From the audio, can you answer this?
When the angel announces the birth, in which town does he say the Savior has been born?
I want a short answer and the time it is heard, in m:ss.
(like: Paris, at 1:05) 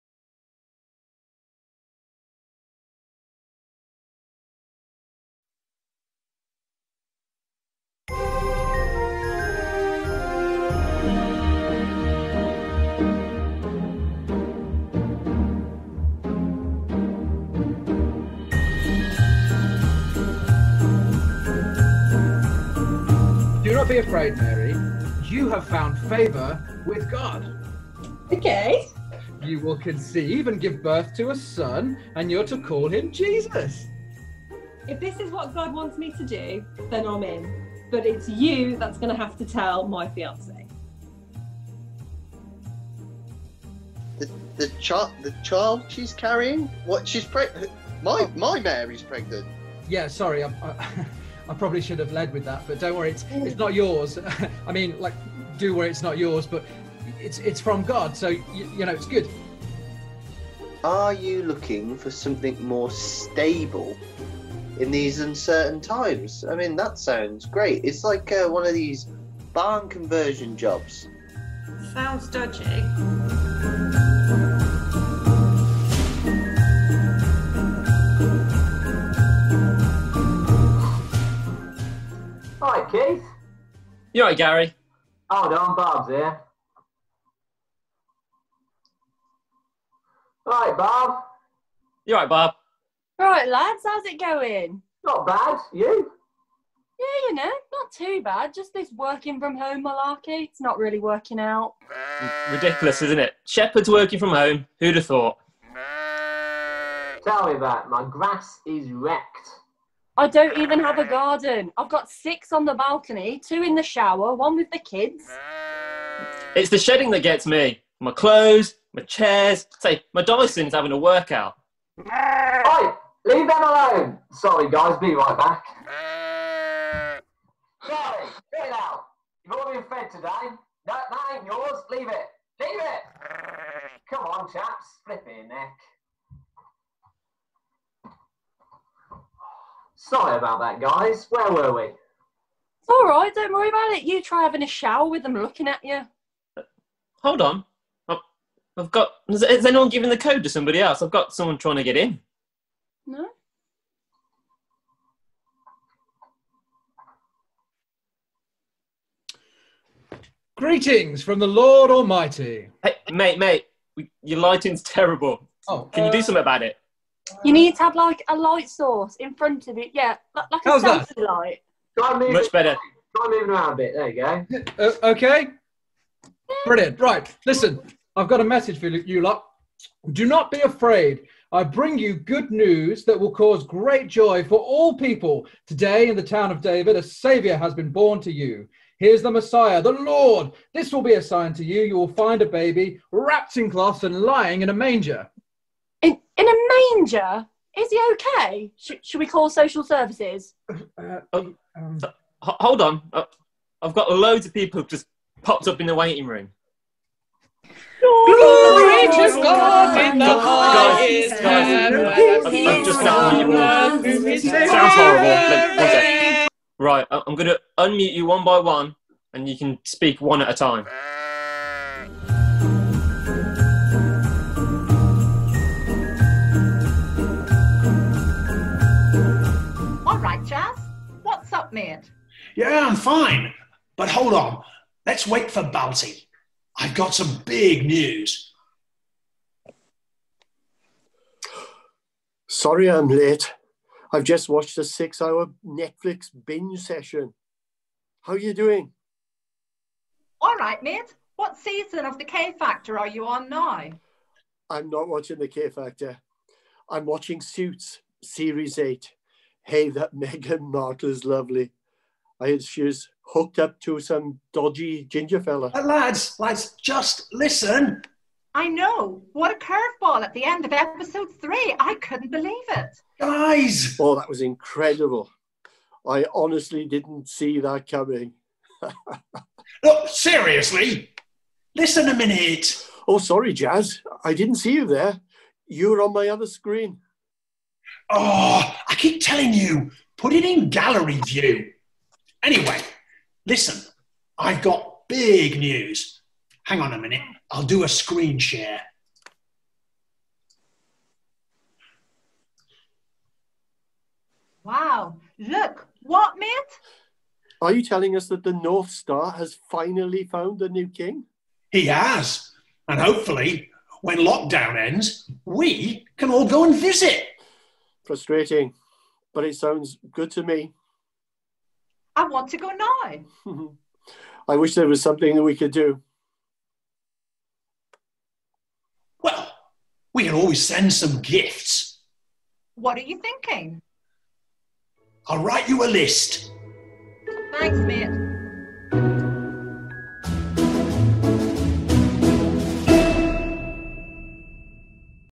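Town of David, at 3:06.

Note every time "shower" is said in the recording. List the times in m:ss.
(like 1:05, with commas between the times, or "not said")
1:53, 2:24.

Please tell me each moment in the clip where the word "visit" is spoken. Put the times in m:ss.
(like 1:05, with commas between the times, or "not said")
5:16.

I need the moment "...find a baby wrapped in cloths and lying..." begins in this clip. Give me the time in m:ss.
3:12.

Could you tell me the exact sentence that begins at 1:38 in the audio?
Just this working from home malarkey.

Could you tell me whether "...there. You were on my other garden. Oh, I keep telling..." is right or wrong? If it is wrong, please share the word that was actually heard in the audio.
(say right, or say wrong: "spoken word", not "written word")
wrong: "screen", not "garden".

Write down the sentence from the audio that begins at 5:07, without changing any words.
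Are you telling us that the North Star has finally found the new king?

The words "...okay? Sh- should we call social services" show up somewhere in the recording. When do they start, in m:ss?
3:18.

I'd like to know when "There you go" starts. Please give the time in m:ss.
2:53.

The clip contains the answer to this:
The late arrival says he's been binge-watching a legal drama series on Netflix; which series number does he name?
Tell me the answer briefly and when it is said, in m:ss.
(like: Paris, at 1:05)
8, at 4:18.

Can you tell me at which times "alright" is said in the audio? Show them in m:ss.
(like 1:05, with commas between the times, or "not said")
1:24, 1:32.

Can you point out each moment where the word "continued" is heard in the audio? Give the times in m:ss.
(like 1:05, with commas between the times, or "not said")
not said.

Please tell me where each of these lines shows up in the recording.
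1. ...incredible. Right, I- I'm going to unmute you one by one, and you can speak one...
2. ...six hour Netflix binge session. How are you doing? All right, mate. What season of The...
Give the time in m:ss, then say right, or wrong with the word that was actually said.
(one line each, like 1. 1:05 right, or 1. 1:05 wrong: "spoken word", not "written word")
1. 3:34 wrong: "horrible", not "incredible"
2. 4:04 right.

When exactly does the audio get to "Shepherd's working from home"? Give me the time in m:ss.
1:43.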